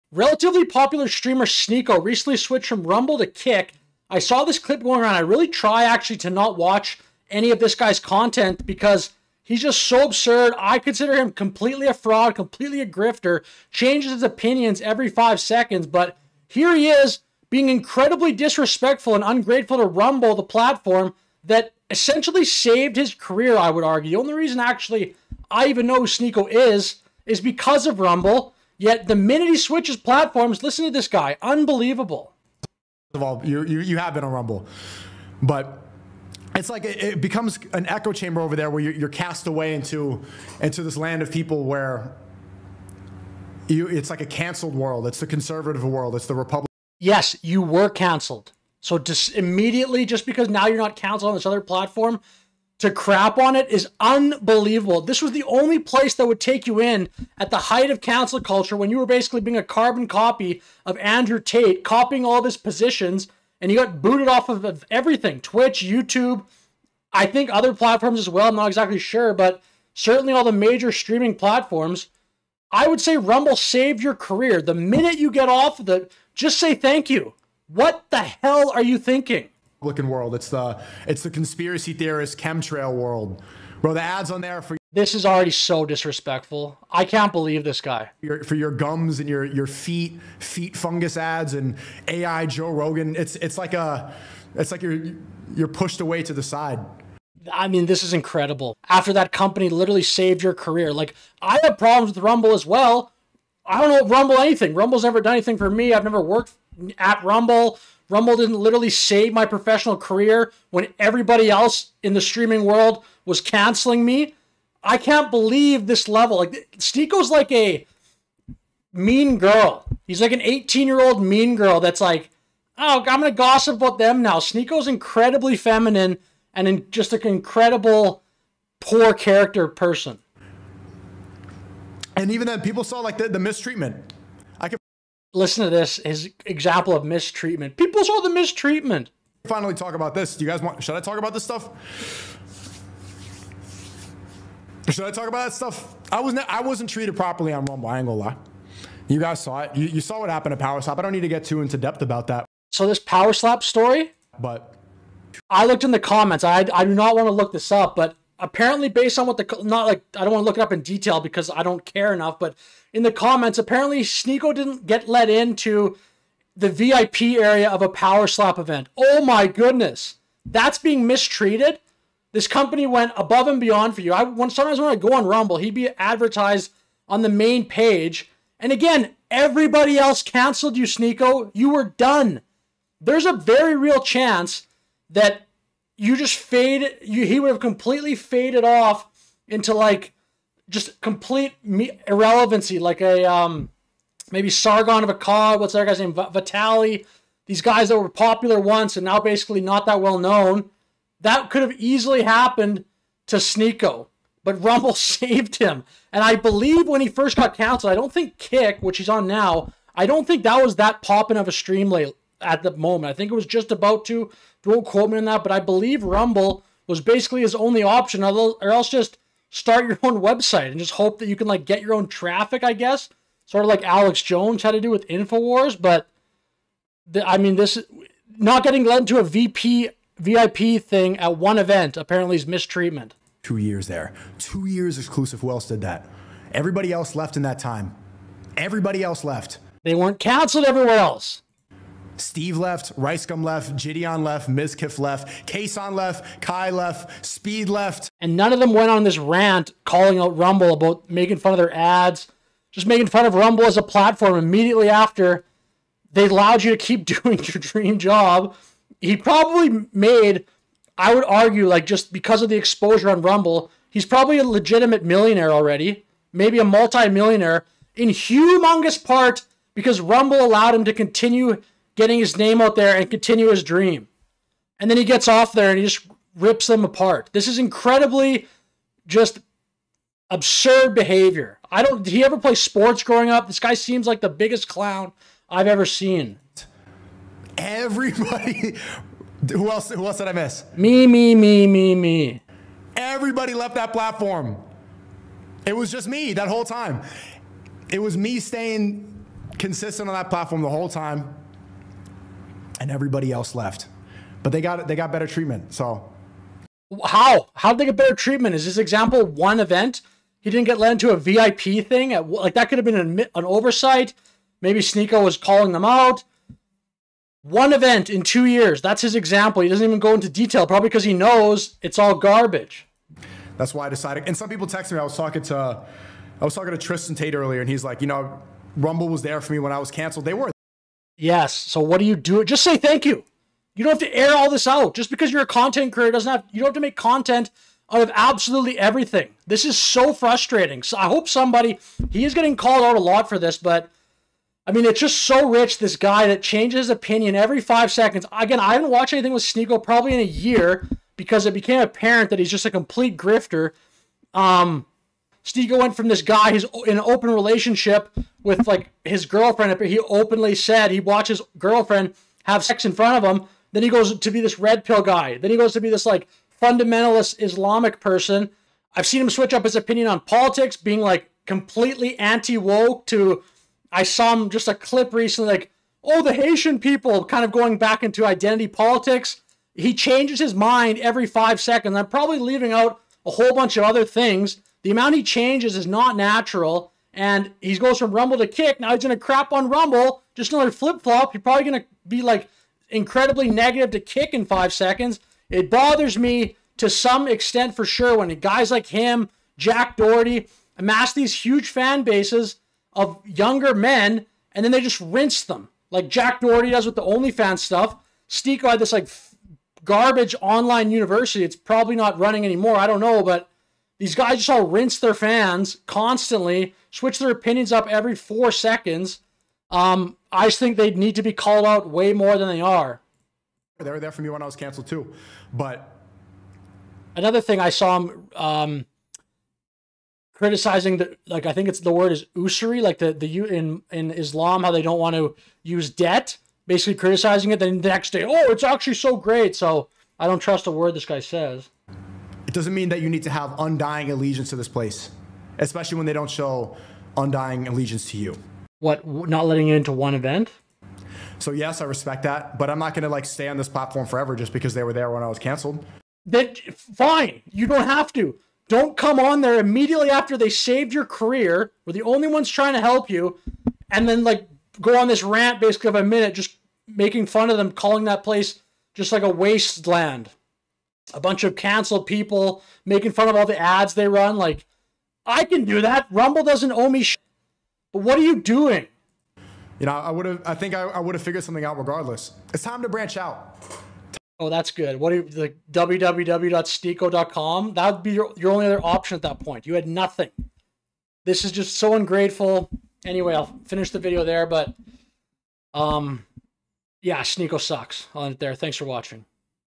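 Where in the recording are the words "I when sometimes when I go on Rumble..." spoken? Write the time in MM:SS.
02:54.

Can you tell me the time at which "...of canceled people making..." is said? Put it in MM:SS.
07:51.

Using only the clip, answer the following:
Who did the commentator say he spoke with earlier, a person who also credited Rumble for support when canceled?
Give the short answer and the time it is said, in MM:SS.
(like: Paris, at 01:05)
Tristan Tate, at 05:26.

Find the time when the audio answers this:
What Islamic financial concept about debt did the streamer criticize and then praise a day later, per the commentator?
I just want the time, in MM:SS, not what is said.
07:12.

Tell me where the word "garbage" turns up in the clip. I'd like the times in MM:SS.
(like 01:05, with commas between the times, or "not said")
05:22, 06:49.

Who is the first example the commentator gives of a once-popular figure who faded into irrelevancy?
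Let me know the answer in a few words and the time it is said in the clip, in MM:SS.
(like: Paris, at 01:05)
Sargon of Akkad, at 03:14.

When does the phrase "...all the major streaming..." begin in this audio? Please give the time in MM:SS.
01:10.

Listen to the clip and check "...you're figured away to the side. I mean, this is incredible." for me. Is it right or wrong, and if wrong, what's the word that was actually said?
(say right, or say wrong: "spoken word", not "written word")
wrong: "pushed", not "figured".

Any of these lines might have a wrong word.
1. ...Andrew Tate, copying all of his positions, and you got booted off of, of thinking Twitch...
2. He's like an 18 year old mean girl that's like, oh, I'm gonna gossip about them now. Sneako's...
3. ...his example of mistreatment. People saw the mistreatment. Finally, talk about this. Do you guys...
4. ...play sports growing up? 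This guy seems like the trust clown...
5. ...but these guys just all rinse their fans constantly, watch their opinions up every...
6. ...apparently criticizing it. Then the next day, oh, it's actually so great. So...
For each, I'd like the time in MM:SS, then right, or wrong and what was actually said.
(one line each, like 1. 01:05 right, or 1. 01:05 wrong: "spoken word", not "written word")
1. 01:00 wrong: "everything", not "thinking"
2. 02:00 right
3. 02:16 right
4. 04:42 wrong: "biggest", not "trust"
5. 06:53 wrong: "switch", not "watch"
6. 07:16 wrong: "basically", not "apparently".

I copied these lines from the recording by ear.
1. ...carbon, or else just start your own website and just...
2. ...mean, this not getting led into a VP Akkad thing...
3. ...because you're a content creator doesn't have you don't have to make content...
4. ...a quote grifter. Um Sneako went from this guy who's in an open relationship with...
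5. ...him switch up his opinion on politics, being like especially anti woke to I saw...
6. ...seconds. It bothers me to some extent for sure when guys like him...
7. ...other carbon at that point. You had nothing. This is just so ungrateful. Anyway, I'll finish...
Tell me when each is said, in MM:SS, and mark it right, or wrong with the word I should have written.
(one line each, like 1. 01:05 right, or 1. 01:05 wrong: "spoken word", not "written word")
1. 03:37 wrong: "option", not "carbon"
2. 03:47 wrong: "VIP", not "Akkad"
3. 05:35 right
4. 05:52 wrong: "complete", not "quote"
5. 06:09 wrong: "completely", not "especially"
6. 06:34 right
7. 08:08 wrong: "option", not "carbon".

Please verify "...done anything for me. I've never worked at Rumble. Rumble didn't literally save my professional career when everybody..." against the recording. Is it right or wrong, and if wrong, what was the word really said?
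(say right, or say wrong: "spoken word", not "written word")
right.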